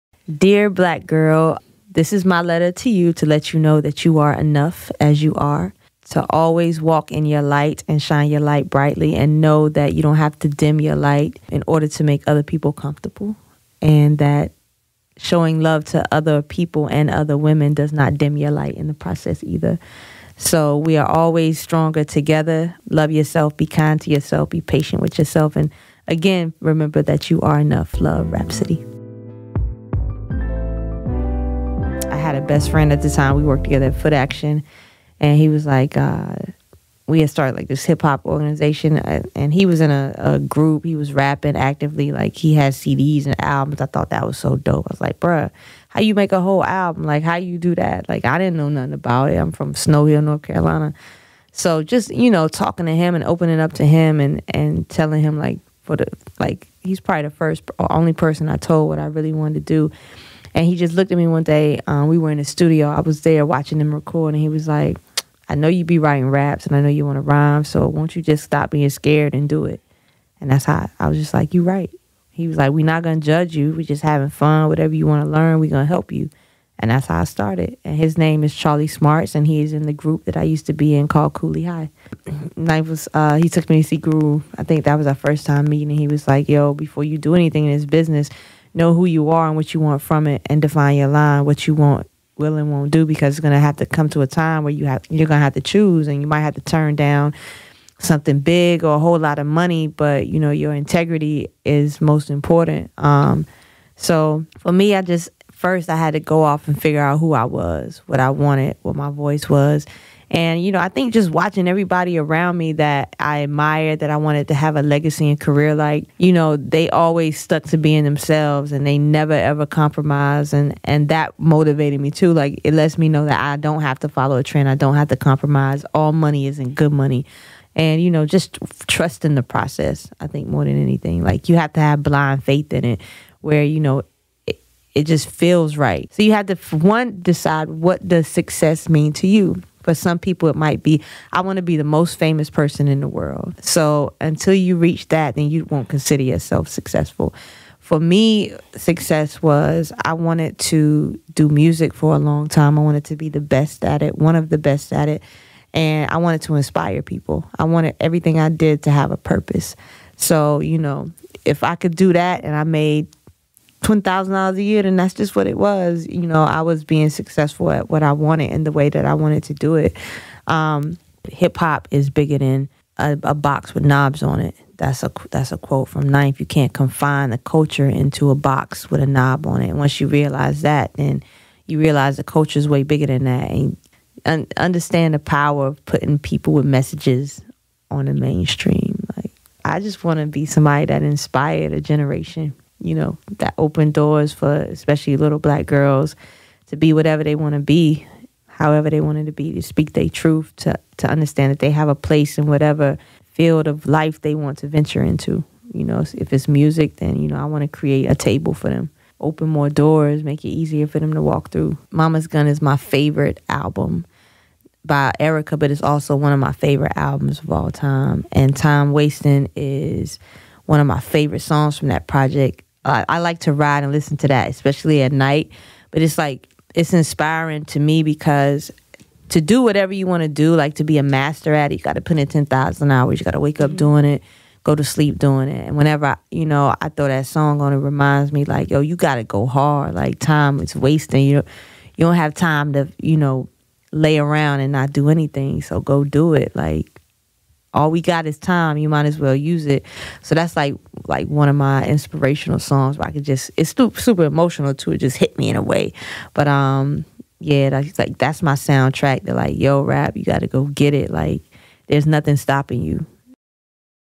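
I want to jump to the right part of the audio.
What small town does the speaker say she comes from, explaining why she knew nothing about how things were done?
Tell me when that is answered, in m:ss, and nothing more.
0:49.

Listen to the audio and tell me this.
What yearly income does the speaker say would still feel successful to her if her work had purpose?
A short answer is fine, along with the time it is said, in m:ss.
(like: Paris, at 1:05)
$20,000, at 2:43.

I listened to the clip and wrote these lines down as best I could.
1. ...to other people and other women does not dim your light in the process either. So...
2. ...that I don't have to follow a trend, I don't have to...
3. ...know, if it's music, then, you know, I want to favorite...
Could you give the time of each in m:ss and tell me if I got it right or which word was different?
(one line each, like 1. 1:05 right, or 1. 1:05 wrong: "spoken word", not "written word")
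1. 0:15 right
2. 2:03 right
3. 3:25 wrong: "create", not "favorite".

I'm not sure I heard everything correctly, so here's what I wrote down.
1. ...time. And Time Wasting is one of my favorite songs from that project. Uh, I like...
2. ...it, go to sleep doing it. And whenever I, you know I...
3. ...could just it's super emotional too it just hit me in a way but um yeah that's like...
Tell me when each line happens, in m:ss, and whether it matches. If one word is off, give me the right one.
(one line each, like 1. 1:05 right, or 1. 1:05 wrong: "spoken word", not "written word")
1. 3:37 right
2. 3:54 right
3. 4:13 right.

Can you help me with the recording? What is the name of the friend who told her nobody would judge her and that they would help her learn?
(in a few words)
Charlie Smarts.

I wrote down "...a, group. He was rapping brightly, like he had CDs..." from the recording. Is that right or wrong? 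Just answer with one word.
wrong.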